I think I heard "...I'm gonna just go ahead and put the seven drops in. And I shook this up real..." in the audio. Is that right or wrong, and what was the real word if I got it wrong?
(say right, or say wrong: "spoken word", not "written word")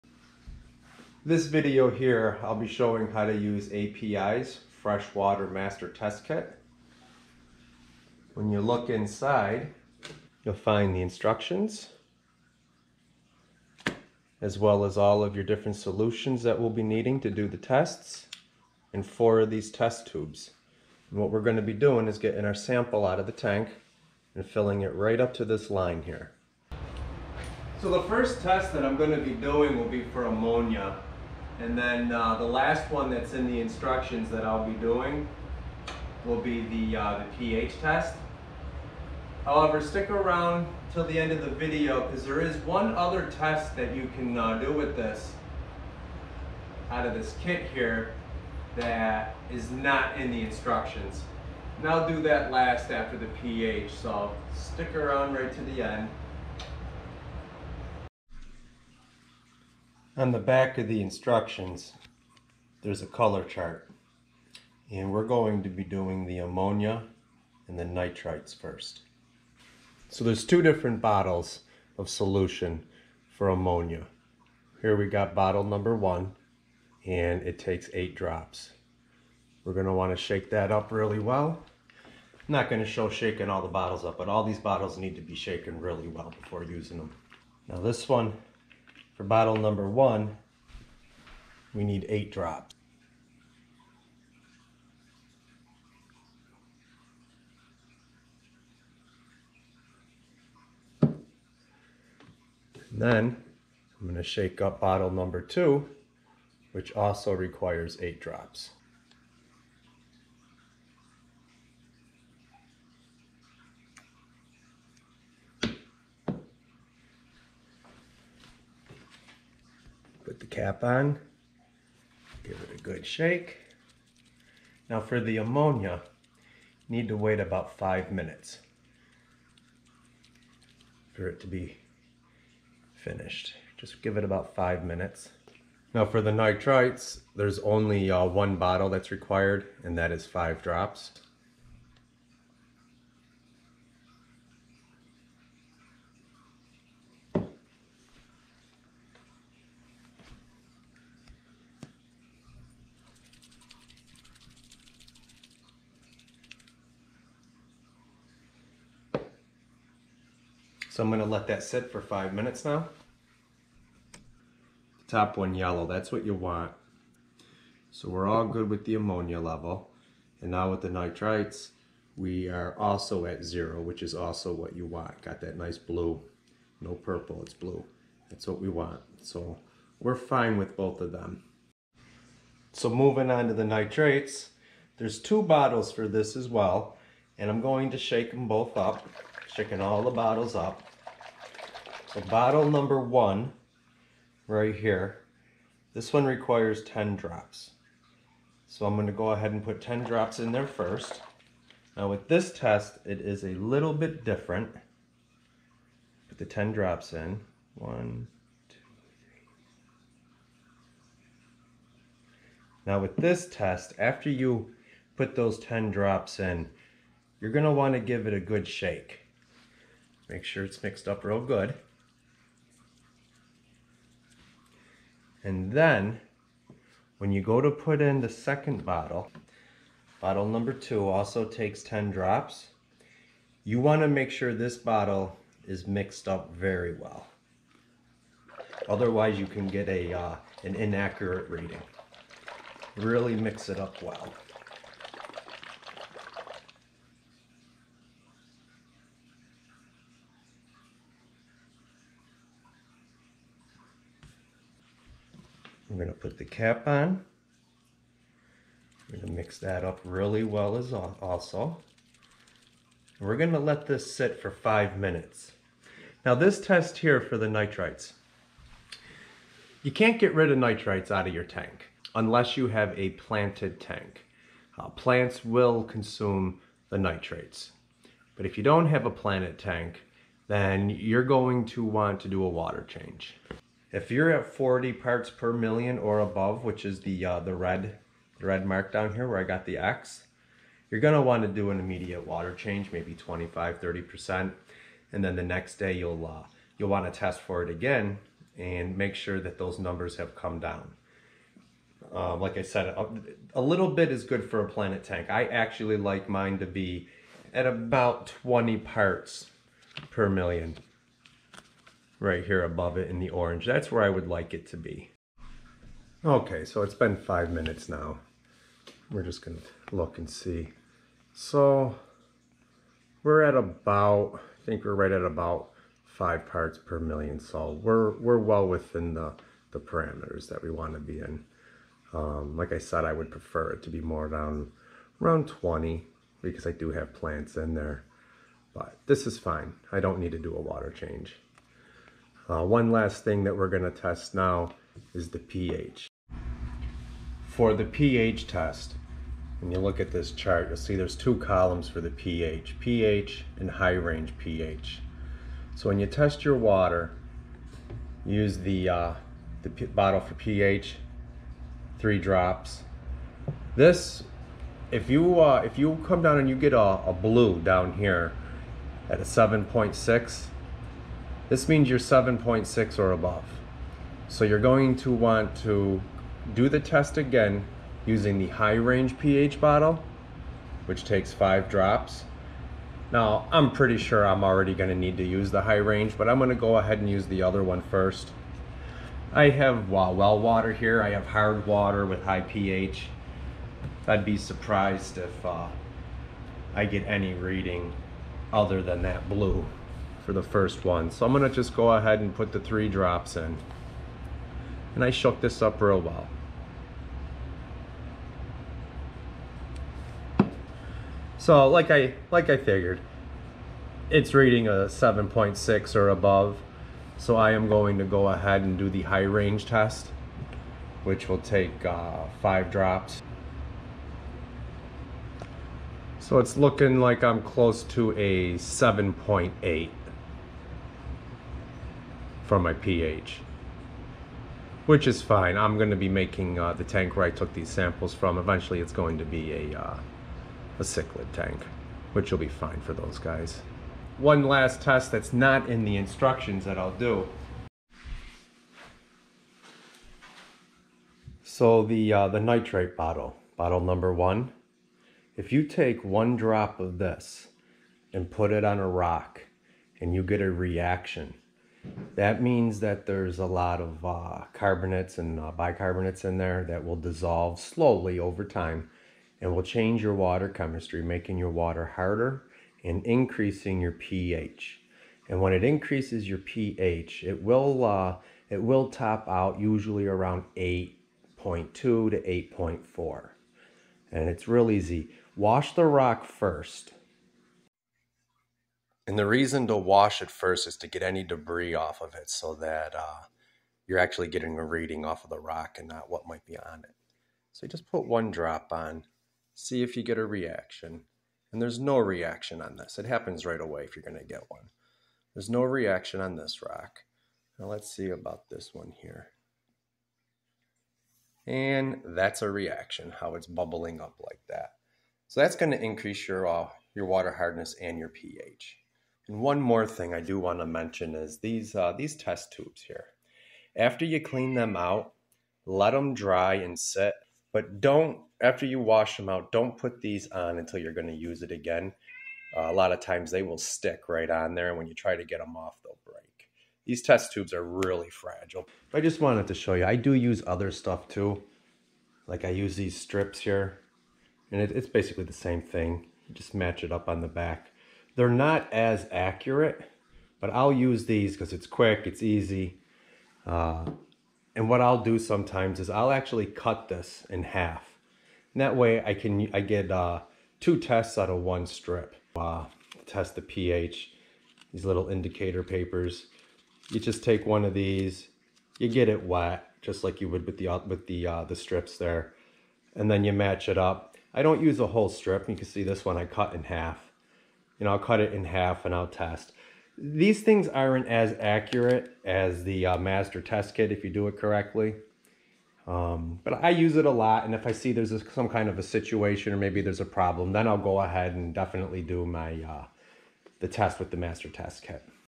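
wrong: "three", not "seven".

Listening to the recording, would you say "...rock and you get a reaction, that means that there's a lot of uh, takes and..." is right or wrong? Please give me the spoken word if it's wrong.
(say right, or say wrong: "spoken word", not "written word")
wrong: "carbonates", not "takes".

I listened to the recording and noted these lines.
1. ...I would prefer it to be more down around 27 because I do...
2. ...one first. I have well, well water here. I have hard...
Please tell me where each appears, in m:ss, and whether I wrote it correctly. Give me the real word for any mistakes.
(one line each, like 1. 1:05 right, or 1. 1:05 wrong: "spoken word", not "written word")
1. 5:33 wrong: "20", not "27"
2. 6:27 right.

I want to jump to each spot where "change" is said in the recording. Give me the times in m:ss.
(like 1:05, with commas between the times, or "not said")
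4:42, 4:52, 5:40, 7:49.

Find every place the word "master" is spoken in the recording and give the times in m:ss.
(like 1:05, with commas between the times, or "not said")
0:05, 9:42, 9:54.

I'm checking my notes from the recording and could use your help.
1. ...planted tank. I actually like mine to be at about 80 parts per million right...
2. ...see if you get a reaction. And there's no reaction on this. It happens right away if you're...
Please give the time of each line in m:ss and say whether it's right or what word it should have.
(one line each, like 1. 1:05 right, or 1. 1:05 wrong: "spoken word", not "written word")
1. 5:04 wrong: "20", not "80"
2. 8:19 right.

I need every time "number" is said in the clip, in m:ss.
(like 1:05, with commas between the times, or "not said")
1:15, 1:29, 1:45, 3:12, 3:50, 4:59, 7:33.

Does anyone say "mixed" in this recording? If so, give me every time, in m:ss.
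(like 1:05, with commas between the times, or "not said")
3:40, 3:55.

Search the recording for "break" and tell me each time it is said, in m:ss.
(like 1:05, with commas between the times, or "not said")
8:56.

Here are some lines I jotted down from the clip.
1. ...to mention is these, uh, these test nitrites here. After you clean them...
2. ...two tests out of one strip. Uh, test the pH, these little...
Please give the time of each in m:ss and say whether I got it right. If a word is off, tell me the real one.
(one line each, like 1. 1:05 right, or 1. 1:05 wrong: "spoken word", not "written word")
1. 8:40 wrong: "tubes", not "nitrites"
2. 9:20 right.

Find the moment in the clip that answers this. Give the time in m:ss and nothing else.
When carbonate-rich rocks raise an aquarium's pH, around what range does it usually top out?
8:00.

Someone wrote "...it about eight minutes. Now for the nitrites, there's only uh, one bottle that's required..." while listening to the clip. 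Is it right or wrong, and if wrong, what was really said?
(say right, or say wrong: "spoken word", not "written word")
wrong: "five", not "eight".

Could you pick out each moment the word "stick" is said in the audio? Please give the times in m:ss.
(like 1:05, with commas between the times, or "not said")
0:39, 0:54, 8:53.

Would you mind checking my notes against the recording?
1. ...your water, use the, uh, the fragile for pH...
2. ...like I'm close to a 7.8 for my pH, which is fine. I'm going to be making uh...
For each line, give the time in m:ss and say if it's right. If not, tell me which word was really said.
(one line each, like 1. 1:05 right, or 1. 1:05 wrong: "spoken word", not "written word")
1. 5:56 wrong: "bottle", not "fragile"
2. 7:07 right.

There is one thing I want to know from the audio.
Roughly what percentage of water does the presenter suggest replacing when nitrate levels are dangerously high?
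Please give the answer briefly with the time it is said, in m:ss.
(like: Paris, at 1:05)
25-30%, at 4:53.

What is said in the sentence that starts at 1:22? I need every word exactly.
I'm not gonna show shaking all the bottles up, but all these bottles need to be shaken really well before using them.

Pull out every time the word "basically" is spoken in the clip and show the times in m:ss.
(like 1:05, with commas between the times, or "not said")
9:04.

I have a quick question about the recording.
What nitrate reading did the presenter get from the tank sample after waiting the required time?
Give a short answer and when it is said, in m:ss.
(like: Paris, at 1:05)
5 ppm, at 5:26.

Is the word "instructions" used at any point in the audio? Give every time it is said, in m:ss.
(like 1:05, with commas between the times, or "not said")
0:11, 0:33, 0:50, 1:01, 7:25.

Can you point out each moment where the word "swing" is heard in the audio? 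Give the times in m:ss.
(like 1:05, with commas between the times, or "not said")
not said.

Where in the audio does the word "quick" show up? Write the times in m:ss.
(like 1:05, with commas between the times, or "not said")
9:11.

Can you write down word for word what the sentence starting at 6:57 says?
So I am going to go ahead and do the high range test, which will take uh, five drops.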